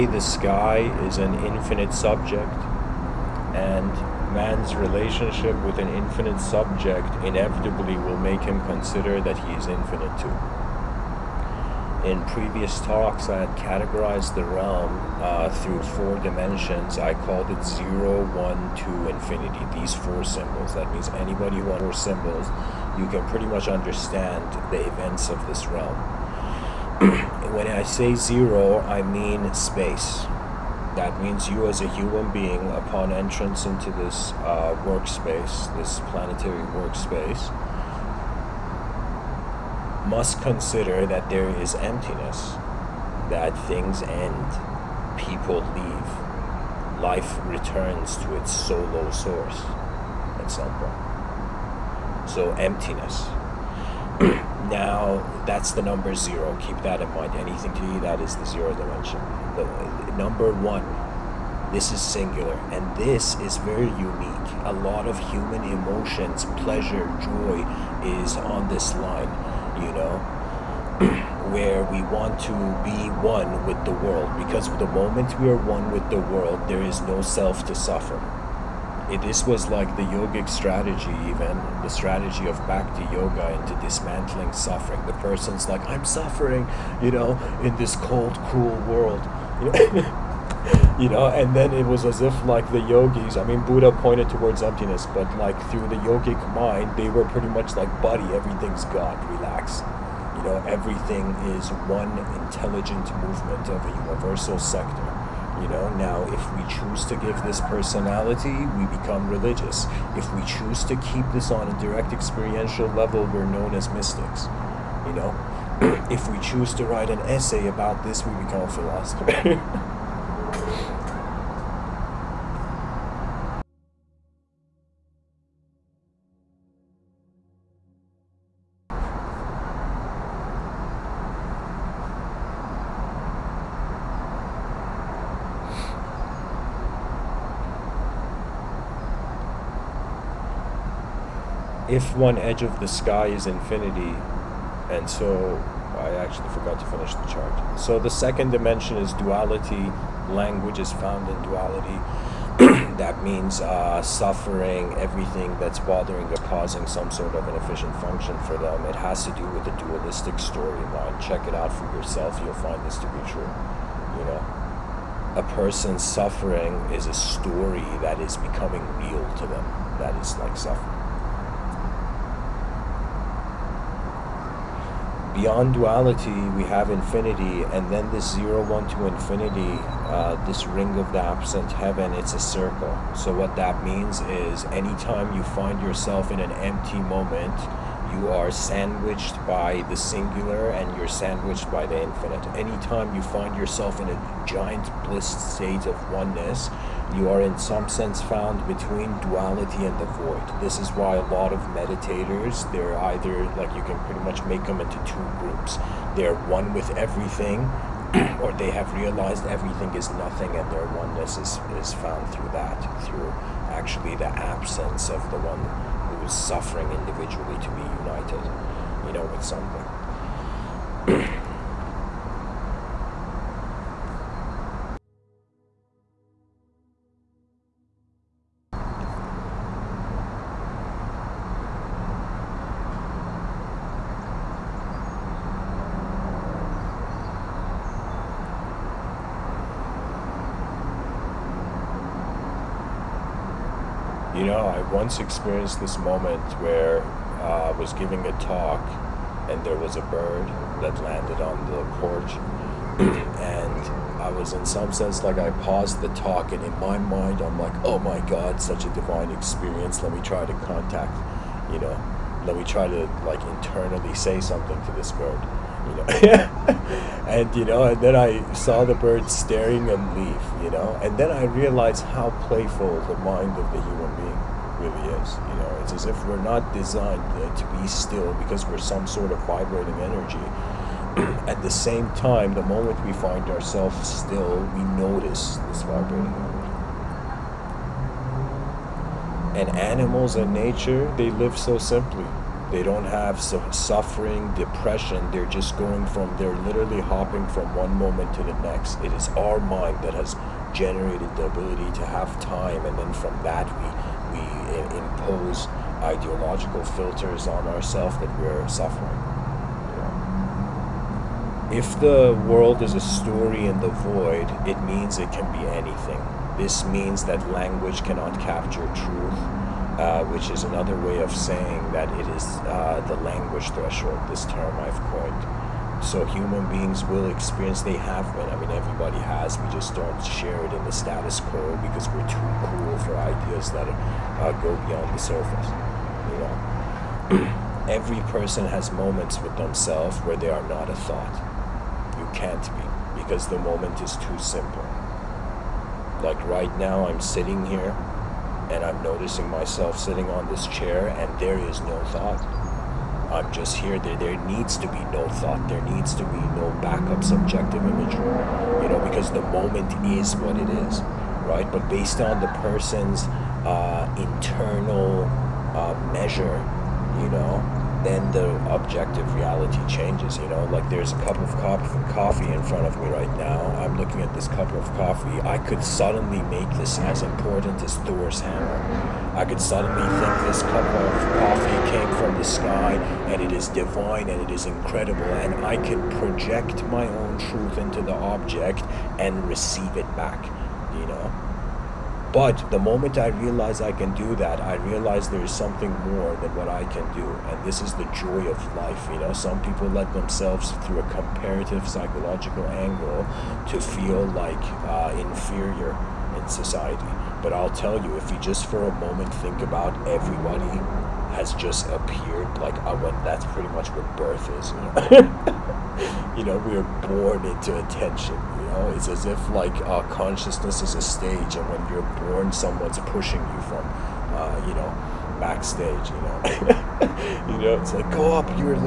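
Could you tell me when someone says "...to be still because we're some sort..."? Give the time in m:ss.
4:37.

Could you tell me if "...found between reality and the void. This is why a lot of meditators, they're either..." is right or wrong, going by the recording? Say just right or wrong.
wrong.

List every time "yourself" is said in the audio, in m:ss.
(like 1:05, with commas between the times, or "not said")
2:41, 3:05, 3:13.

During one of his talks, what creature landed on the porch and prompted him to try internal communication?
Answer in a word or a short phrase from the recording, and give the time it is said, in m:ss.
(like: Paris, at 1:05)
a bird, at 4:09.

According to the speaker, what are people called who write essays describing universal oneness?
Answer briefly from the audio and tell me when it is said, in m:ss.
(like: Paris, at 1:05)
philosophers, at 1:58.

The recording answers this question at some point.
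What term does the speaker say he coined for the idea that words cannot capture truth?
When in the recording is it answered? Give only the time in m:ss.
5:23.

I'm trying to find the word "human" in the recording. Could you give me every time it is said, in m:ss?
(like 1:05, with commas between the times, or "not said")
0:31, 1:05, 4:33, 5:26.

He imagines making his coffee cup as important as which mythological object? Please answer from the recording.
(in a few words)
Thor's hammer.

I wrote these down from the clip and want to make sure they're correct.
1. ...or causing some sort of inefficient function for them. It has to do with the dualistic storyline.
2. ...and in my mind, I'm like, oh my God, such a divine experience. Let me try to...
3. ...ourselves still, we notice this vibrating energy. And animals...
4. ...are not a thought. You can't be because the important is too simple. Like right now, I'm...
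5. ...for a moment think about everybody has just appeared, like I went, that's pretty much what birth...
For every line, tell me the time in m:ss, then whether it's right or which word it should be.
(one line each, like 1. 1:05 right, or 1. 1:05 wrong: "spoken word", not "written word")
1. 2:36 right
2. 4:16 right
3. 4:43 right
4. 5:40 wrong: "moment", not "important"
5. 6:48 right.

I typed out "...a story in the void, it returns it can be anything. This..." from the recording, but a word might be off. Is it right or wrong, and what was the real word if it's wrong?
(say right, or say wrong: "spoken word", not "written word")
wrong: "means", not "returns".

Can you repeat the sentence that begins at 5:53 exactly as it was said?
There, there needs to be no thought.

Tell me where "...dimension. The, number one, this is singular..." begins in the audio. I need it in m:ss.
0:58.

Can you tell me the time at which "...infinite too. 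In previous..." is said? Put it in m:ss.
0:09.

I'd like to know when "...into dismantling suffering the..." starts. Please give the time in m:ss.
1:23.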